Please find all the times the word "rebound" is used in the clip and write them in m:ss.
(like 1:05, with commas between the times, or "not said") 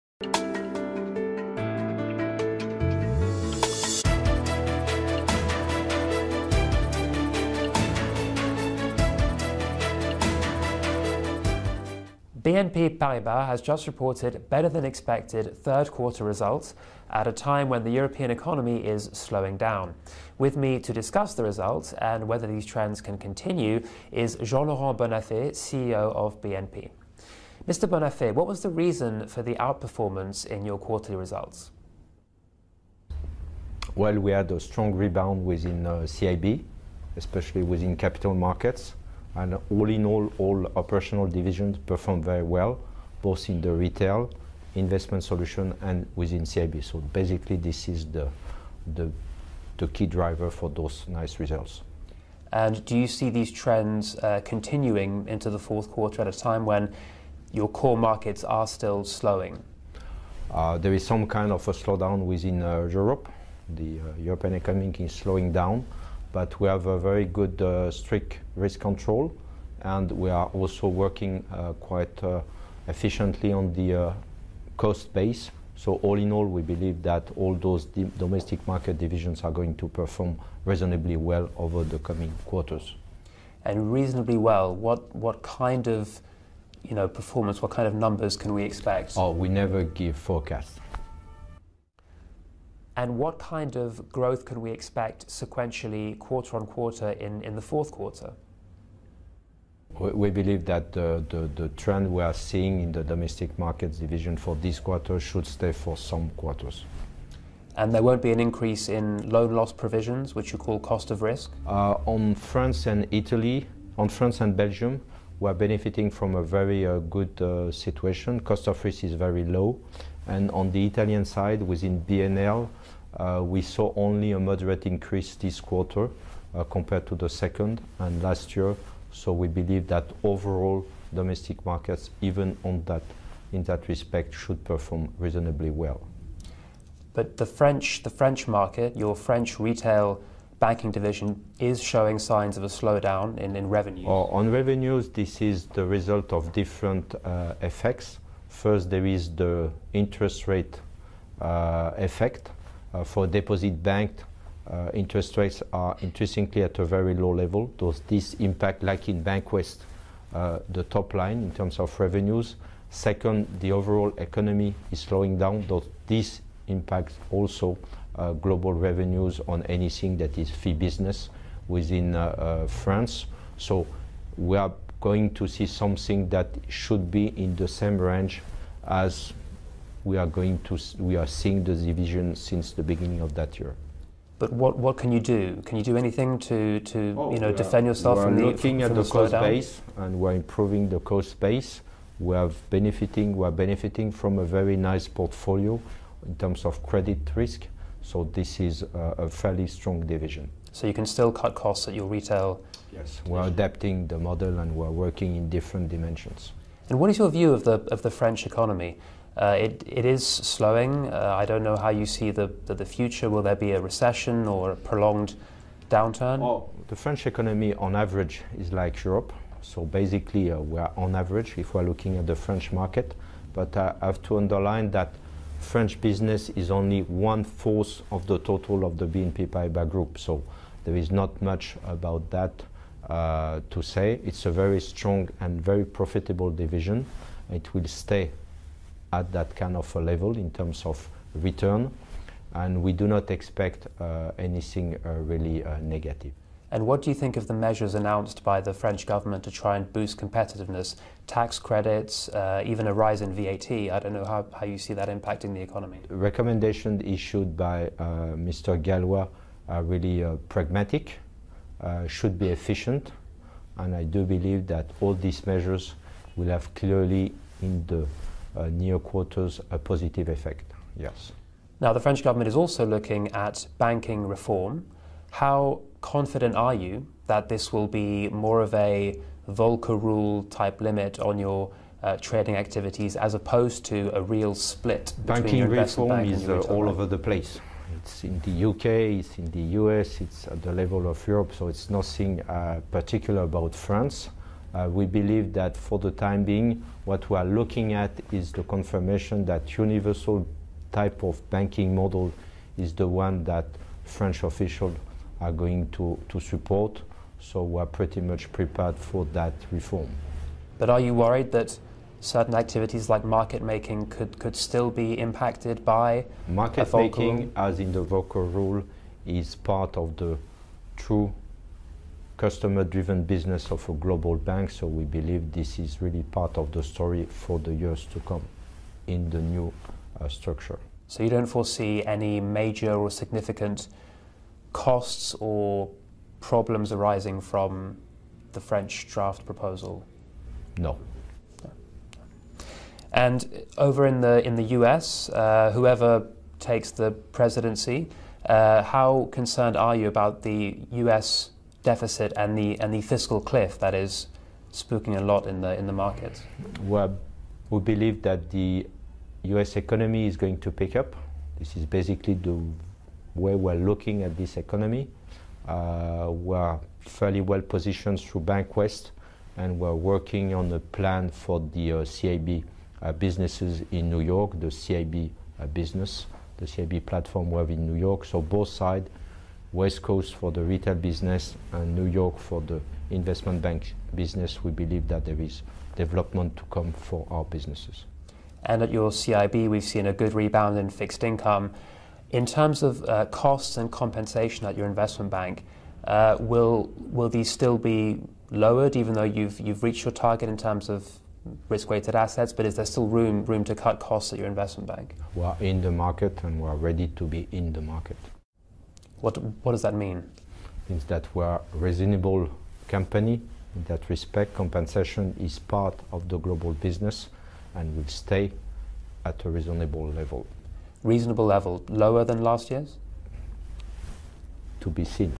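0:34, 6:30.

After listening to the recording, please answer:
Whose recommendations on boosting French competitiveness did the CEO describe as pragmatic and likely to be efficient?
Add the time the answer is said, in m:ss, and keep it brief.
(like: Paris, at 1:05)
Mr. Gallois, at 4:18.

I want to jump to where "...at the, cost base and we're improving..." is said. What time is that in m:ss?
3:08.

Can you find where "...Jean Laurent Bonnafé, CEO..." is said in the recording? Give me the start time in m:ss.
0:24.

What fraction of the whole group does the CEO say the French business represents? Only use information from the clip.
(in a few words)
one-fourth.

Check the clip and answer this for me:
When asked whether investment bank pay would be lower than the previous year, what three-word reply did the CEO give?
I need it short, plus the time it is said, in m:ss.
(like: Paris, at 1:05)
To be seen, at 7:04.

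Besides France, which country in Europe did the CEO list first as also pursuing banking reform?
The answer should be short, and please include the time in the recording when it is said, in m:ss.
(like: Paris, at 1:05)
UK, at 4:48.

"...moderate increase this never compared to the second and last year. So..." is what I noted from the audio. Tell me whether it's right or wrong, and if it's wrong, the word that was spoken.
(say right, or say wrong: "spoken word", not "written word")
wrong: "quarter", not "never".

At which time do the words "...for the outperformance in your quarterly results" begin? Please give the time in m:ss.
0:29.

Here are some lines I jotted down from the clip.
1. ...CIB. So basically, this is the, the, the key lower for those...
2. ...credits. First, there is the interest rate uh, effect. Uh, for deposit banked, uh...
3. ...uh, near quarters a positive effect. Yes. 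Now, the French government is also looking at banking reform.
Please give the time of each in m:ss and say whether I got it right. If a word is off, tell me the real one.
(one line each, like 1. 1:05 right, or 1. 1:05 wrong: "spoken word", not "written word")
1. 0:46 wrong: "driver", not "lower"
2. 2:27 wrong: "effects", not "credits"
3. 4:28 right.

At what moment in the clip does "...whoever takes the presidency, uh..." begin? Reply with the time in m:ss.
5:45.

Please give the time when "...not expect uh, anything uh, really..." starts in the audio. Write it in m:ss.
4:03.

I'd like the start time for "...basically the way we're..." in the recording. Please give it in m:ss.
6:01.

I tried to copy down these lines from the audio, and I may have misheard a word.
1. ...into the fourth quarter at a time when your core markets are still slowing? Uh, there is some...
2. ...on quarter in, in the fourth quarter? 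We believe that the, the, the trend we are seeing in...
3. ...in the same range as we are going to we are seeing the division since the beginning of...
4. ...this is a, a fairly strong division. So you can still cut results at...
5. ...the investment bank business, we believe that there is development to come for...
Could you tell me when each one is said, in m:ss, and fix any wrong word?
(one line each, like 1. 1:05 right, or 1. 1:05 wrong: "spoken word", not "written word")
1. 0:55 right
2. 1:36 right
3. 2:57 right
4. 3:18 wrong: "costs", not "results"
5. 6:22 right.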